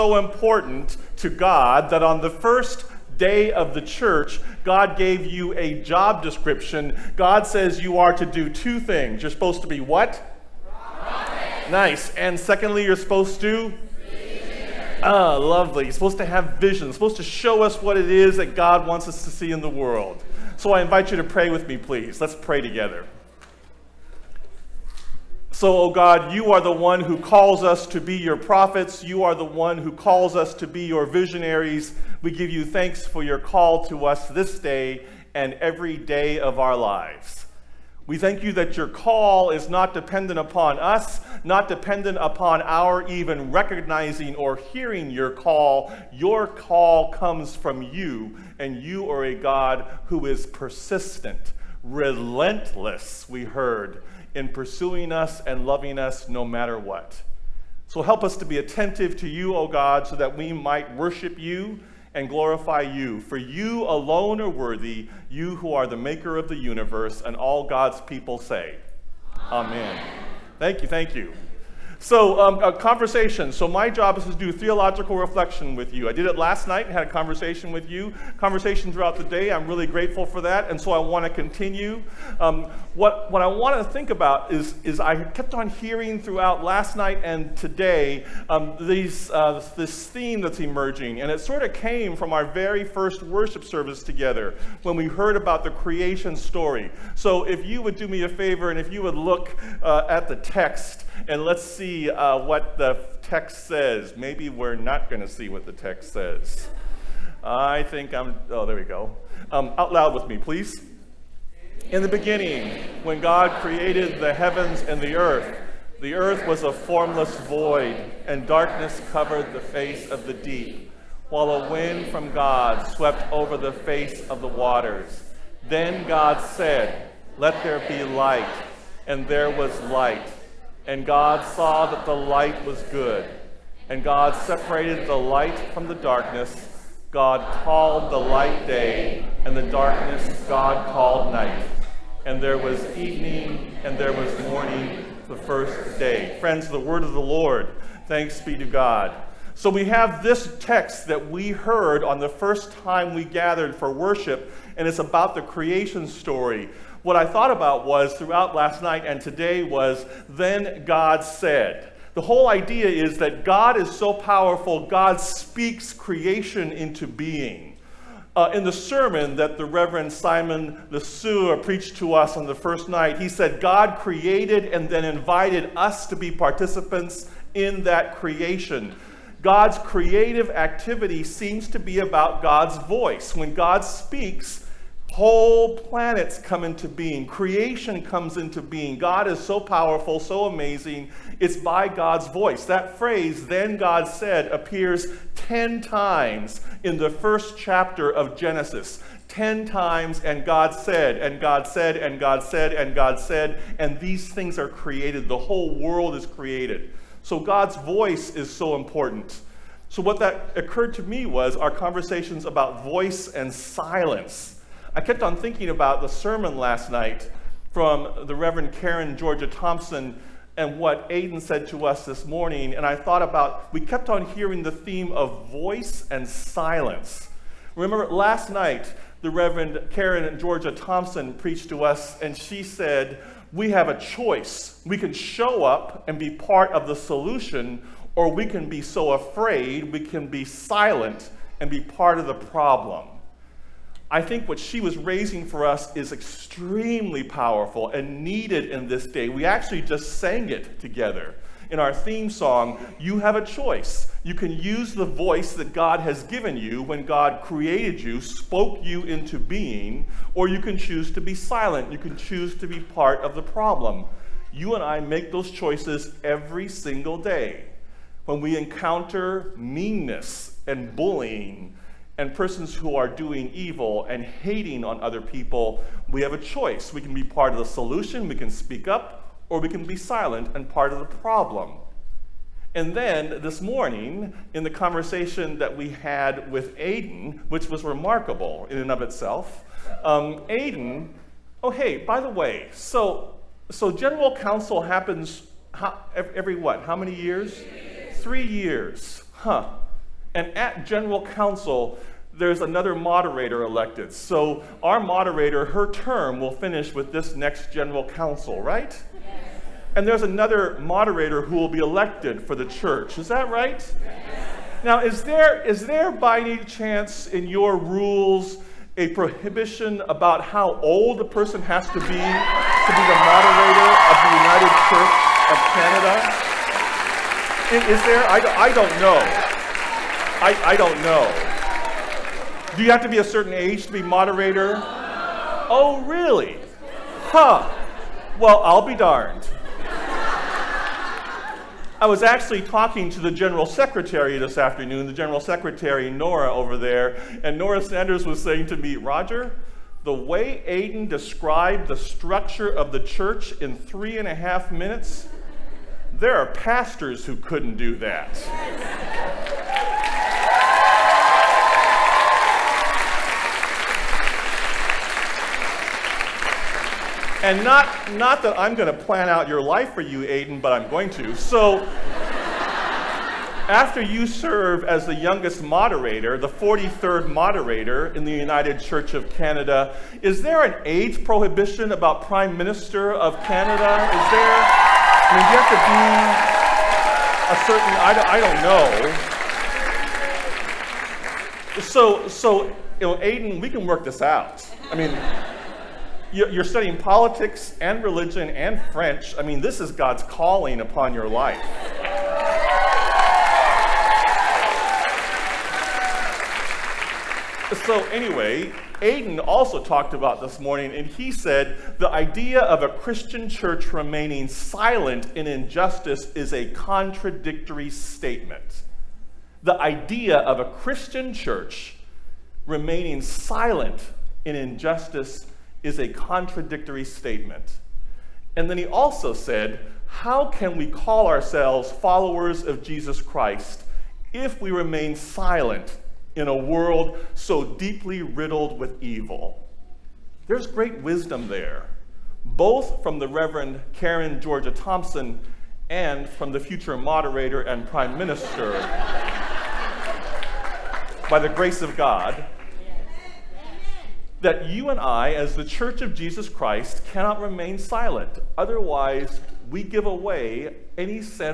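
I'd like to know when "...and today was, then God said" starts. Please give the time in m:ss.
2:39.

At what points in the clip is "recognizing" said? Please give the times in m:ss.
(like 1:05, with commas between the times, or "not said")
0:43.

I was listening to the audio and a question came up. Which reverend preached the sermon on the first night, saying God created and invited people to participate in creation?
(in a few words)
Simon Lesueur.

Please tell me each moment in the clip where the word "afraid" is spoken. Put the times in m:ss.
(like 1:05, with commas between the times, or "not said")
3:59.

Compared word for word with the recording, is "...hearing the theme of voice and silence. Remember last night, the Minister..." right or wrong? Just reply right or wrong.
wrong.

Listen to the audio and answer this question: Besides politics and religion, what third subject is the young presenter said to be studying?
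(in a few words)
French.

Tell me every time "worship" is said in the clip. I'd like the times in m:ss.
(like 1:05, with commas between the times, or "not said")
1:00, 1:33, 2:33.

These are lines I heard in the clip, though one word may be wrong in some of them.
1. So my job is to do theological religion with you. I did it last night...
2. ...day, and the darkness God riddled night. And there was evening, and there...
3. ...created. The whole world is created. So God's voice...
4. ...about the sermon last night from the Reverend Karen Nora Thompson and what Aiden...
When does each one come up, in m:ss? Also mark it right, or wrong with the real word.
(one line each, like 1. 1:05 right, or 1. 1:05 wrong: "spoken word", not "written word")
1. 1:13 wrong: "reflection", not "religion"
2. 2:18 wrong: "called", not "riddled"
3. 3:24 right
4. 3:35 wrong: "Georgia", not "Nora".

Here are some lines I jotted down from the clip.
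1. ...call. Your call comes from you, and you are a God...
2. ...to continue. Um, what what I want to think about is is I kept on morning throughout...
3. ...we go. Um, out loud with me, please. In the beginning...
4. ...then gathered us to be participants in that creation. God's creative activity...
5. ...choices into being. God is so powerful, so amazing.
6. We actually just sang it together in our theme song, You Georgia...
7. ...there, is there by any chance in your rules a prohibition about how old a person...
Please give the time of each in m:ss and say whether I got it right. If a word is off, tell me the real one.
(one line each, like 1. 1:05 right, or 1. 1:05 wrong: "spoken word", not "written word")
1. 0:45 right
2. 1:21 wrong: "hearing", not "morning"
3. 1:48 right
4. 2:54 wrong: "invited", not "gathered"
5. 3:08 wrong: "comes", not "choices"
6. 4:09 wrong: "Have", not "Georgia"
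7. 5:15 right.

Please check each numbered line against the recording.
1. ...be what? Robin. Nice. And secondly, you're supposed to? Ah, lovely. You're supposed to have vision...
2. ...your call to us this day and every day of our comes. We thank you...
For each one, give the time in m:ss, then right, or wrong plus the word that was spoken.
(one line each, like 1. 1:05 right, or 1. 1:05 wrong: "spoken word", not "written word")
1. 0:09 right
2. 0:33 wrong: "lives", not "comes".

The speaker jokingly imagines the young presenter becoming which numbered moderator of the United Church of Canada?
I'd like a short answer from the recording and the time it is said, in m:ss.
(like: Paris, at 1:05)
43rd, at 6:16.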